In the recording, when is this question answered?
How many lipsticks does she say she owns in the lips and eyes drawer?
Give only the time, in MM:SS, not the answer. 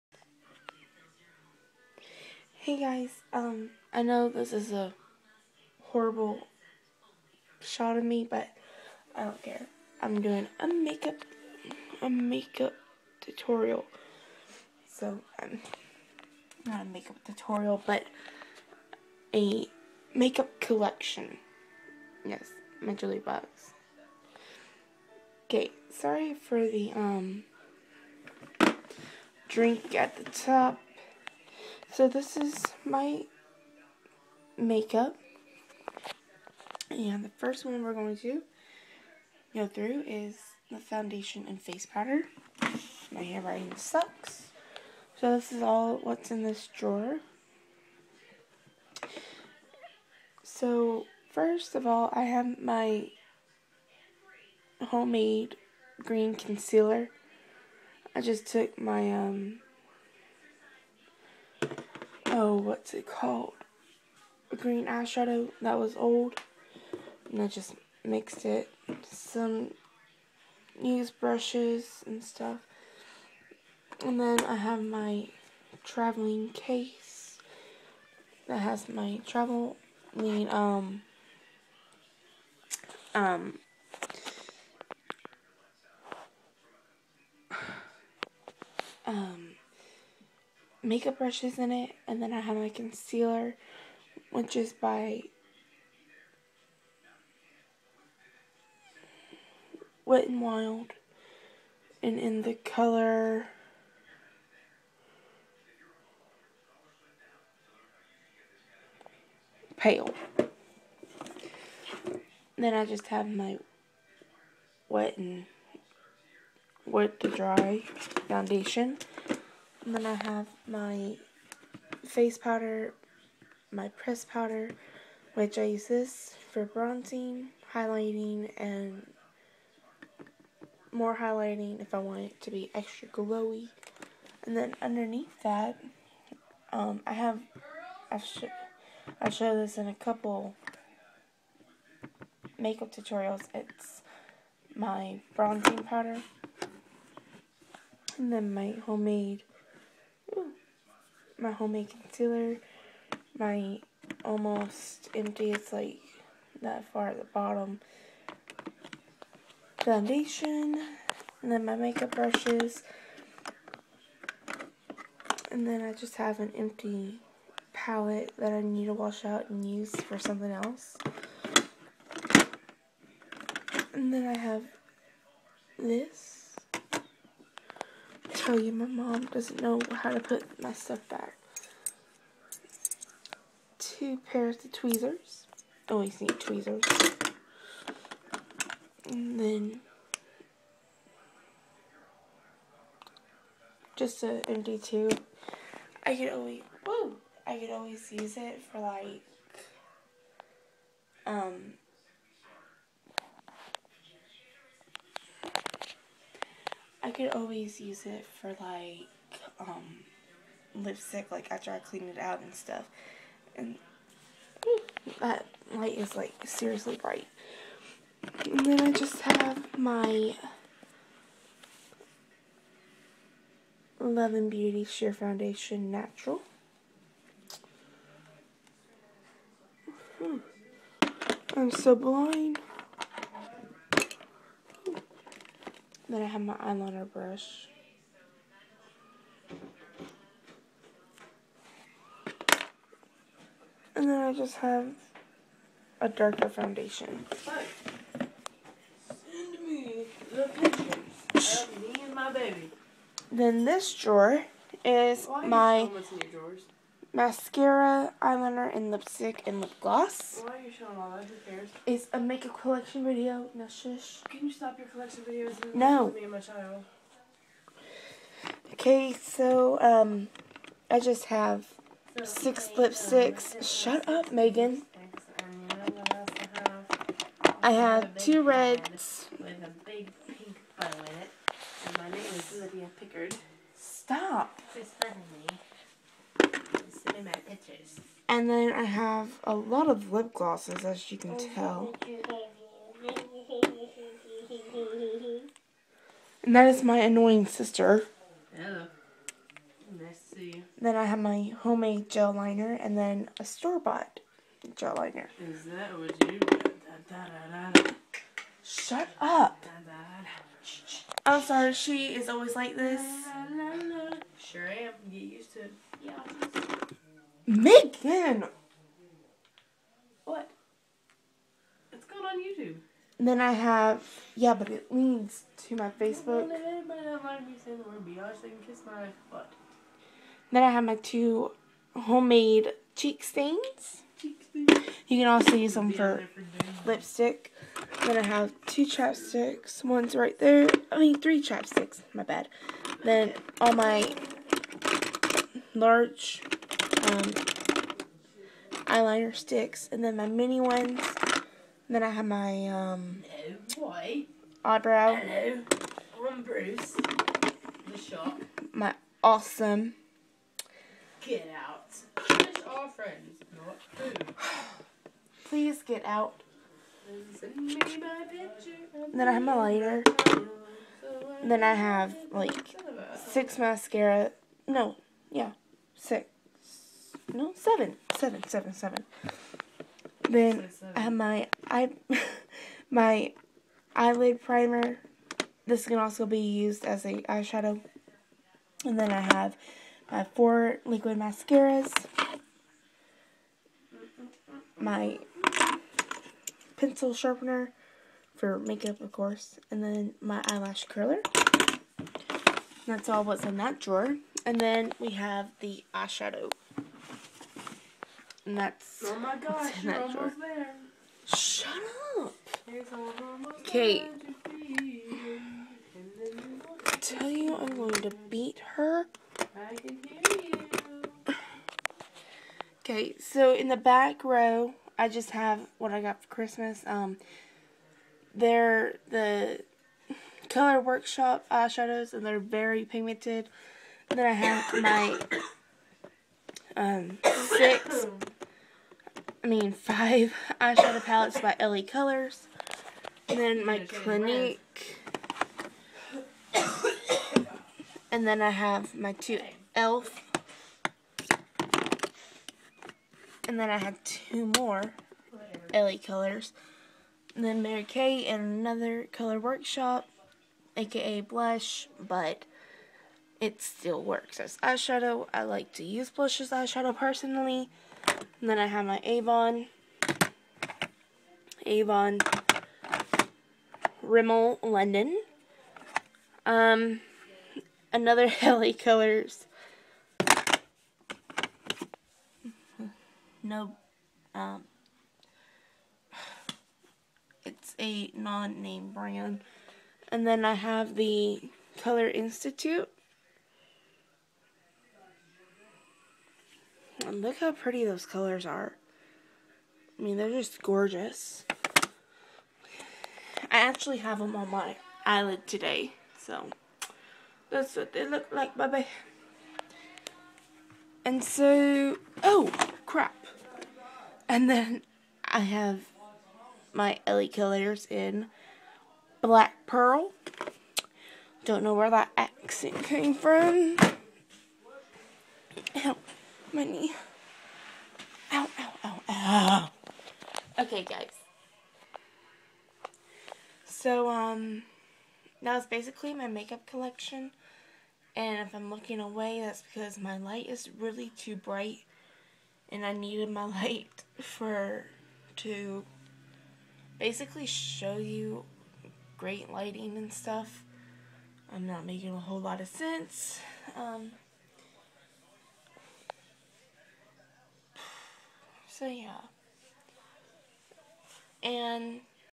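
04:32.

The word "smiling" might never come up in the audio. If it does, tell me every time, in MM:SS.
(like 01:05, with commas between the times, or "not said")
not said.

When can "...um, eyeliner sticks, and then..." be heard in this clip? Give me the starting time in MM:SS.
05:47.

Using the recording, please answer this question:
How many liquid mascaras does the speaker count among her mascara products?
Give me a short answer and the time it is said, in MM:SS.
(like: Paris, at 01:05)
4, at 06:30.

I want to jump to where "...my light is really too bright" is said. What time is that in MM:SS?
08:59.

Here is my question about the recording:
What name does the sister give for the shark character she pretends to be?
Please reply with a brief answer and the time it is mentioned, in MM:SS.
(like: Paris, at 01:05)
Bruce, at 05:56.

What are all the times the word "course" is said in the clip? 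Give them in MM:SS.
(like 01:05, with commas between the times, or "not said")
06:39.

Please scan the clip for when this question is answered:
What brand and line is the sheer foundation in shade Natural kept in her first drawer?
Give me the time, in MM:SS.
03:43.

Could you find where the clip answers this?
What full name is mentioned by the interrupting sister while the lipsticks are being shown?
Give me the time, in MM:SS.
04:42.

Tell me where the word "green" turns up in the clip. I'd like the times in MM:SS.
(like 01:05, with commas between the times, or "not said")
00:56, 01:04.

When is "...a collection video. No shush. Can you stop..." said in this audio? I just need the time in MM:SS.
04:22.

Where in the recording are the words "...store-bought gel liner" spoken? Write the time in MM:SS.
05:03.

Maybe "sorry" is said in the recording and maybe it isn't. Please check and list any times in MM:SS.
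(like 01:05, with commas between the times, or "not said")
00:25, 05:11.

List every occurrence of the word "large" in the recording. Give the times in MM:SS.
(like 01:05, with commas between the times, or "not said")
05:45.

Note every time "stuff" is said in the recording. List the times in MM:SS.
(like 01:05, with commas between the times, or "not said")
01:12, 03:00, 03:32, 09:10.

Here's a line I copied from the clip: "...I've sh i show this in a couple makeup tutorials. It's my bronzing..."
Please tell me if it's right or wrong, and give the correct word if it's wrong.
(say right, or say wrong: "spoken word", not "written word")
right.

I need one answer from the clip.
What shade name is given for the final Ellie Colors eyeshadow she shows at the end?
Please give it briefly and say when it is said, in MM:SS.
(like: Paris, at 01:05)
Black Pearl, at 08:39.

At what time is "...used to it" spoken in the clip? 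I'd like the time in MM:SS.
05:15.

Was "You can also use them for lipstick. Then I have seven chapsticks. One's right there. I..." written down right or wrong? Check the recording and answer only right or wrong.
wrong.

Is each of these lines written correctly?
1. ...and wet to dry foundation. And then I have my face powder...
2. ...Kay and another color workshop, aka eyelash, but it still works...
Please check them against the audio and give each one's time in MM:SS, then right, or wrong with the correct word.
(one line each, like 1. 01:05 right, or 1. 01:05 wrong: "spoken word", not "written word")
1. 01:55 right
2. 07:37 wrong: "blush", not "eyelash".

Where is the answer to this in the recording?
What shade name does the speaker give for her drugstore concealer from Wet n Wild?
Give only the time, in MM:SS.
01:49.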